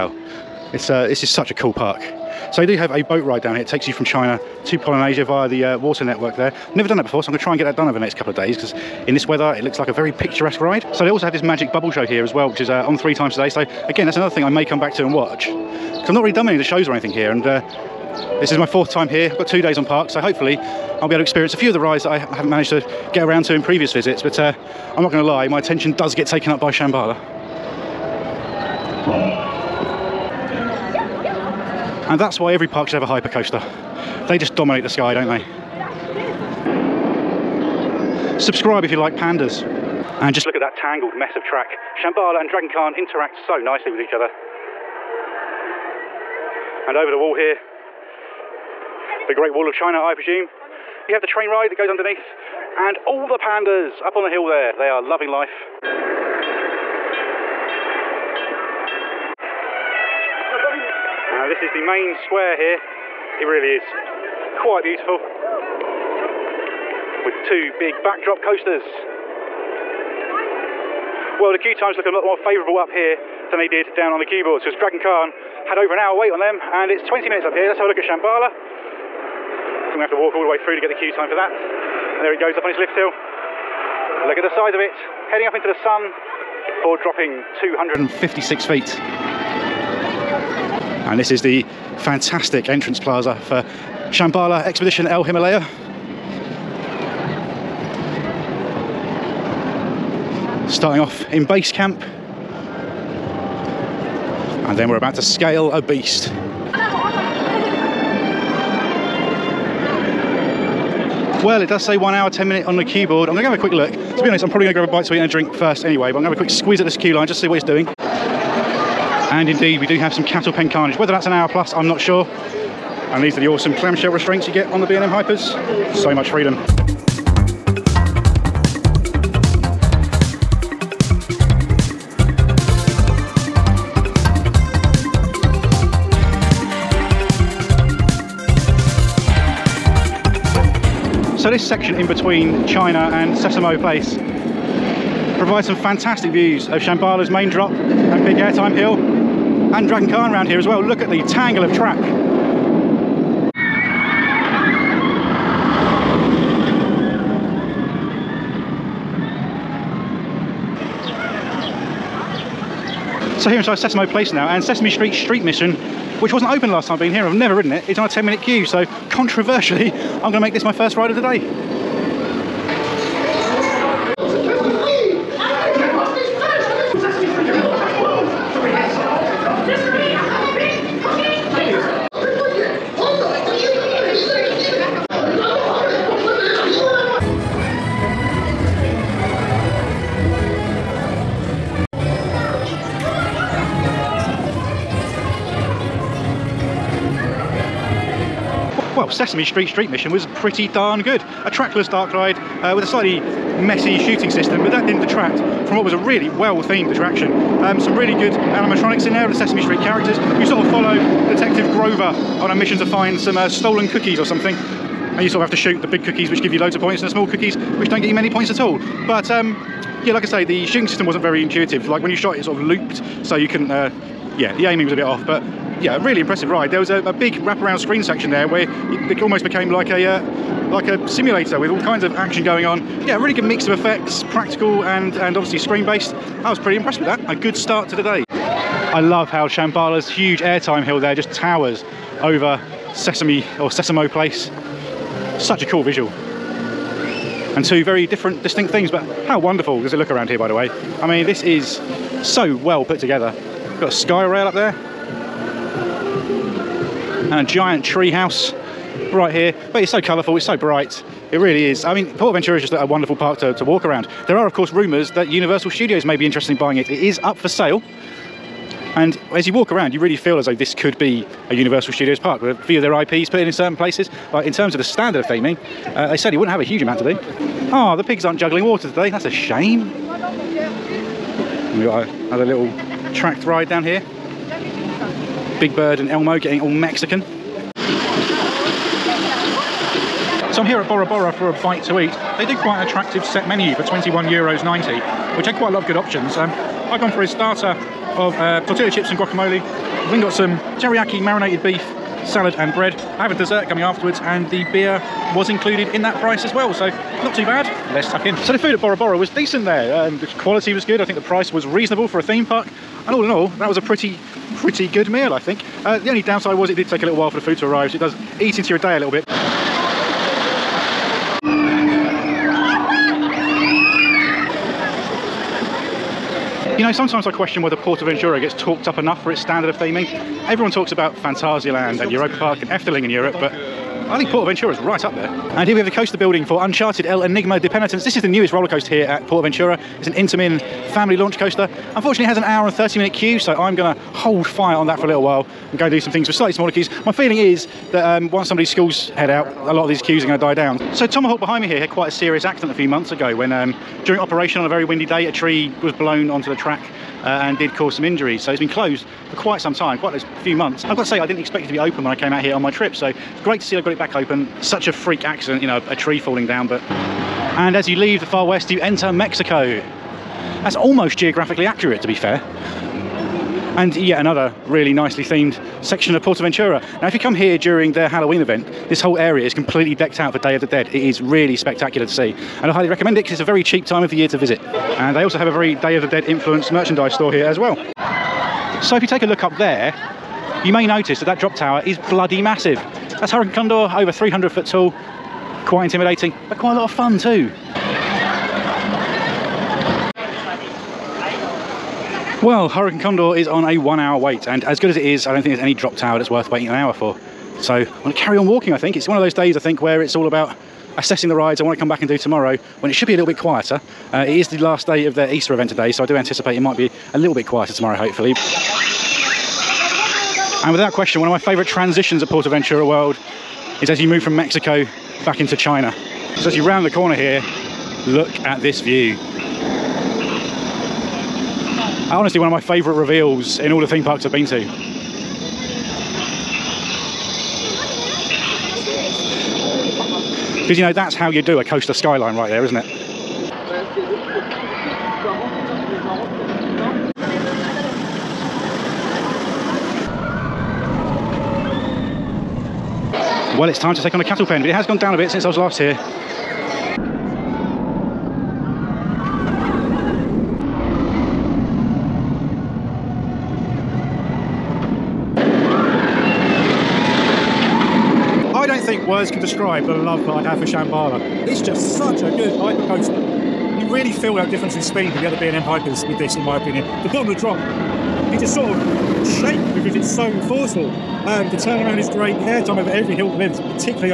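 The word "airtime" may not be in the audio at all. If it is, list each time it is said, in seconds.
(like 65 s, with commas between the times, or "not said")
148 s, 240 s, 482 s.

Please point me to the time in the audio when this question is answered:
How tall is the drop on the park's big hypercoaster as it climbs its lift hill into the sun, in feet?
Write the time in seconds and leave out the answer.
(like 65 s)
87 s.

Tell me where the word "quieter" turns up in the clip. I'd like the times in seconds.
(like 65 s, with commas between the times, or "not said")
413 s, 417 s.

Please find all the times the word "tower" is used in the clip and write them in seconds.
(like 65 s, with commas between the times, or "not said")
241 s, 391 s, 405 s.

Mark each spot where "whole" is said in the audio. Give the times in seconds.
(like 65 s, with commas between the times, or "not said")
378 s.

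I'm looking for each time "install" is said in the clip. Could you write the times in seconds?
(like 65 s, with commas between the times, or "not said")
not said.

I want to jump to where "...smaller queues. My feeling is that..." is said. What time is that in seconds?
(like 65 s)
346 s.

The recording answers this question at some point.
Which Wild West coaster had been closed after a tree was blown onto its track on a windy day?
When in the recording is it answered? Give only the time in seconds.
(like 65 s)
351 s.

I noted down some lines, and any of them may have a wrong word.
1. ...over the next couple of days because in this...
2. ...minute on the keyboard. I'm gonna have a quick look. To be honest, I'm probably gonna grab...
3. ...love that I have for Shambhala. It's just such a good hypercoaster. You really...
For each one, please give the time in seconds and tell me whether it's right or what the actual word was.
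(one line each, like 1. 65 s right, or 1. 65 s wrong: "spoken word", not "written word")
1. 7 s right
2. 112 s right
3. 469 s right.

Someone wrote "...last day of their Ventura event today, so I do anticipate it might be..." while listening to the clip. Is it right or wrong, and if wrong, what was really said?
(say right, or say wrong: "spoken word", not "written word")
wrong: "Easter", not "Ventura".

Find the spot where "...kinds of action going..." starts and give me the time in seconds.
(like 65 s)
231 s.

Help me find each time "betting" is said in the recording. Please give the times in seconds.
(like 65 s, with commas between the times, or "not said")
not said.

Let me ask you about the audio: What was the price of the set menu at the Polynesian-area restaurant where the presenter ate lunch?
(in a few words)
21 euros 90.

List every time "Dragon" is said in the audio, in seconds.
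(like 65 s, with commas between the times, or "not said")
42 s, 74 s, 149 s.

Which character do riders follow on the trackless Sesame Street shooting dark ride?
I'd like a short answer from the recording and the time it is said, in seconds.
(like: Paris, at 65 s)
Detective Grover, at 211 s.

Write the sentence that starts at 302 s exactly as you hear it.
I have a dessert coming afterwards and the beer was included in that price as well.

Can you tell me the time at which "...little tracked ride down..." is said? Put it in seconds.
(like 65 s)
282 s.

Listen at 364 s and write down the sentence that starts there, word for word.
Such a freak accident, you know, a, a tree falling down, but...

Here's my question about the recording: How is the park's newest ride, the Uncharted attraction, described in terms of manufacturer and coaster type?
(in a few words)
Intamin family launch coaster.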